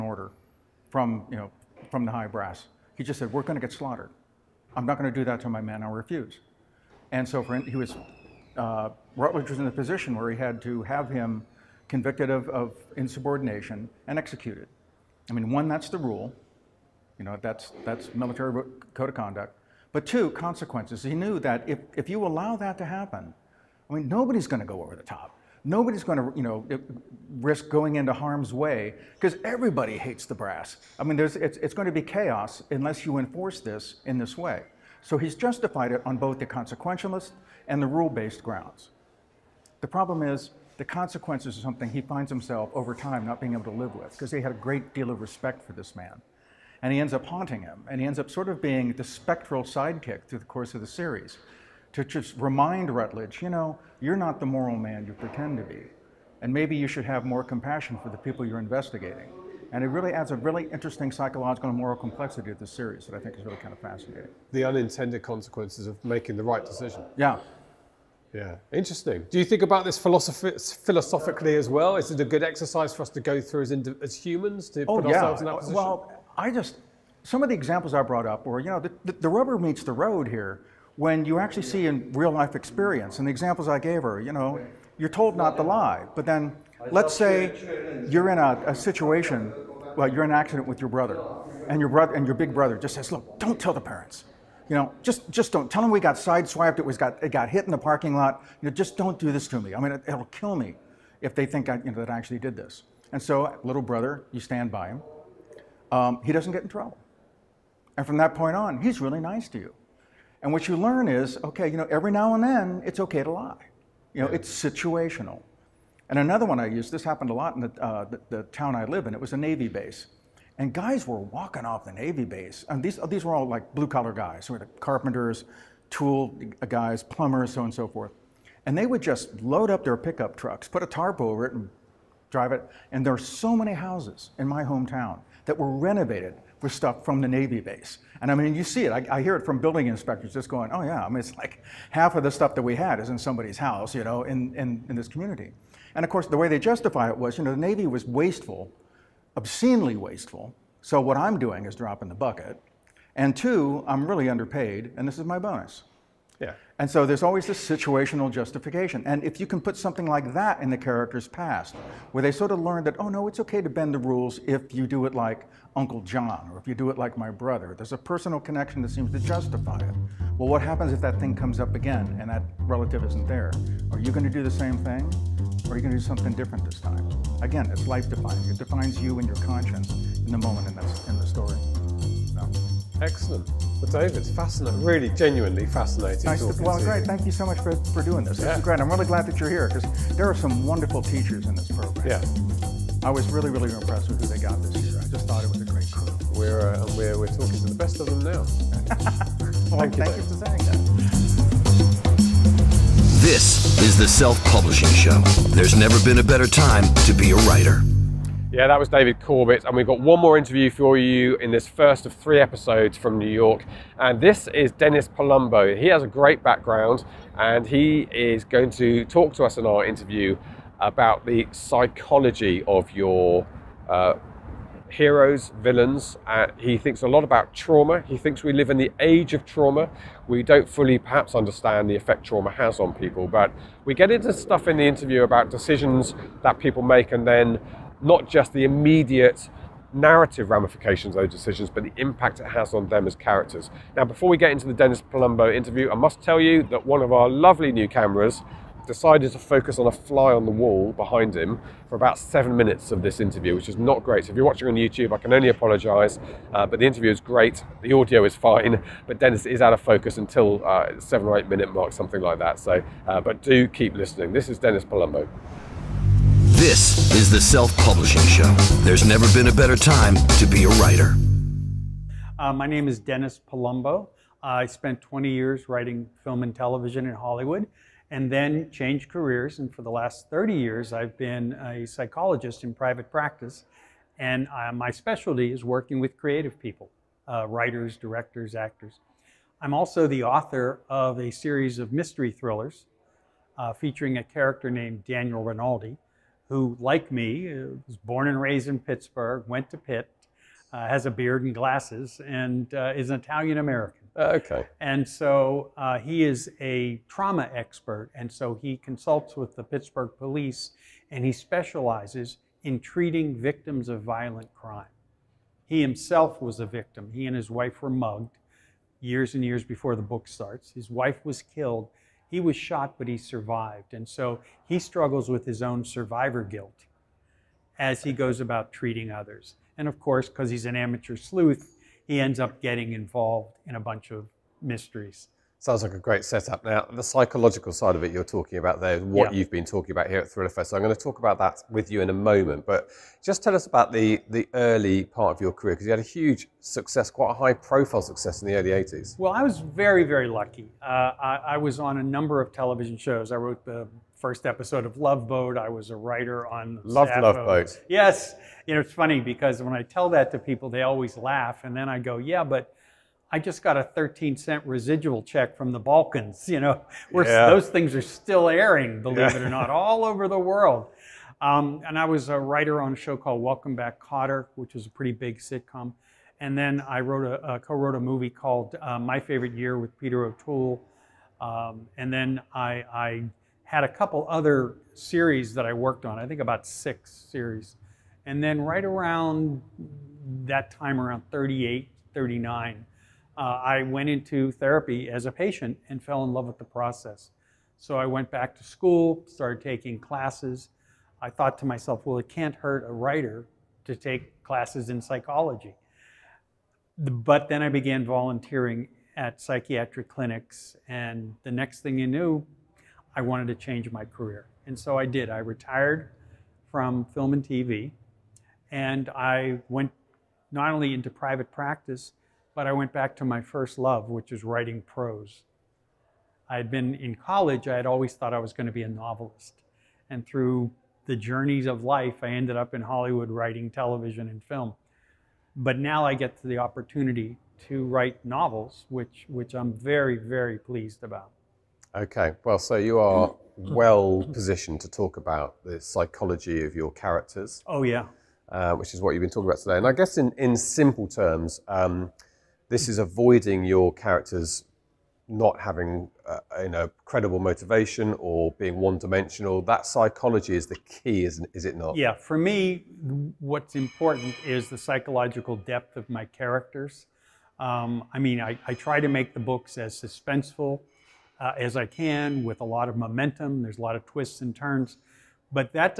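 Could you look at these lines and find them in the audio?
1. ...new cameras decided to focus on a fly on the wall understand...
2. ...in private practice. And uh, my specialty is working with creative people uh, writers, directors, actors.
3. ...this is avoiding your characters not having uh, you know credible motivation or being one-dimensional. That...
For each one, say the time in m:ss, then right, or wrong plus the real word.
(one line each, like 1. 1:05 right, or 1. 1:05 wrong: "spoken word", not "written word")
1. 4:07 wrong: "behind", not "understand"
2. 4:42 right
3. 7:32 right.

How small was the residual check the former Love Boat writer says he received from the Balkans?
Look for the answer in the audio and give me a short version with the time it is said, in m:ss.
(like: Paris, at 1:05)
13 cents, at 6:03.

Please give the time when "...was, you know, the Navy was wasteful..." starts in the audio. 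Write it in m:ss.
2:27.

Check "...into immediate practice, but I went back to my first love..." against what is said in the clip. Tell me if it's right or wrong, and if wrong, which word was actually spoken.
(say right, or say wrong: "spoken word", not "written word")
wrong: "private", not "immediate".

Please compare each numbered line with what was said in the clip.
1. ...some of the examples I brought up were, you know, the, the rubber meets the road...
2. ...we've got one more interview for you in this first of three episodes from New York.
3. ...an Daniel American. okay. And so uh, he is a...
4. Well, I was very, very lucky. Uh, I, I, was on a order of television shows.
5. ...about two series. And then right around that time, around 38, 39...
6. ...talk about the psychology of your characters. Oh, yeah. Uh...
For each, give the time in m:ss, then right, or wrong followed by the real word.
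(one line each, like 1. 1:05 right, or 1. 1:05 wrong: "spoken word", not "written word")
1. 1:17 right
2. 3:29 right
3. 5:03 wrong: "Italian", not "Daniel"
4. 5:49 wrong: "number", not "order"
5. 6:26 wrong: "six", not "two"
6. 7:24 right.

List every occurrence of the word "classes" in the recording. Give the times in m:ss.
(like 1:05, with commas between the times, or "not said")
6:39, 6:44.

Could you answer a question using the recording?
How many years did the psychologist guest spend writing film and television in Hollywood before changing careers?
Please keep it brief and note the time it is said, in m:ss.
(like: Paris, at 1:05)
20, at 4:34.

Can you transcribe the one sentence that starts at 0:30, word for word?
I mean, there's, it's, it's going to be chaos unless you enforce this in this way.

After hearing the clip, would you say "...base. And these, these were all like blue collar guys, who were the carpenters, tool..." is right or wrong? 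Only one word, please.
right.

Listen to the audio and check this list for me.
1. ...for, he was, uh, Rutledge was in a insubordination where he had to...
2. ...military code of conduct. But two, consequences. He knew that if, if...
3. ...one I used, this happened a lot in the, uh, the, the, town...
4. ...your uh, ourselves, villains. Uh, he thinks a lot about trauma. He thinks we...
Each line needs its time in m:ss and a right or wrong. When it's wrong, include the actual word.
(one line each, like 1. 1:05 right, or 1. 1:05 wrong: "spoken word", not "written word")
1. 0:07 wrong: "position", not "insubordination"
2. 0:18 right
3. 1:56 right
4. 3:42 wrong: "heroes", not "ourselves".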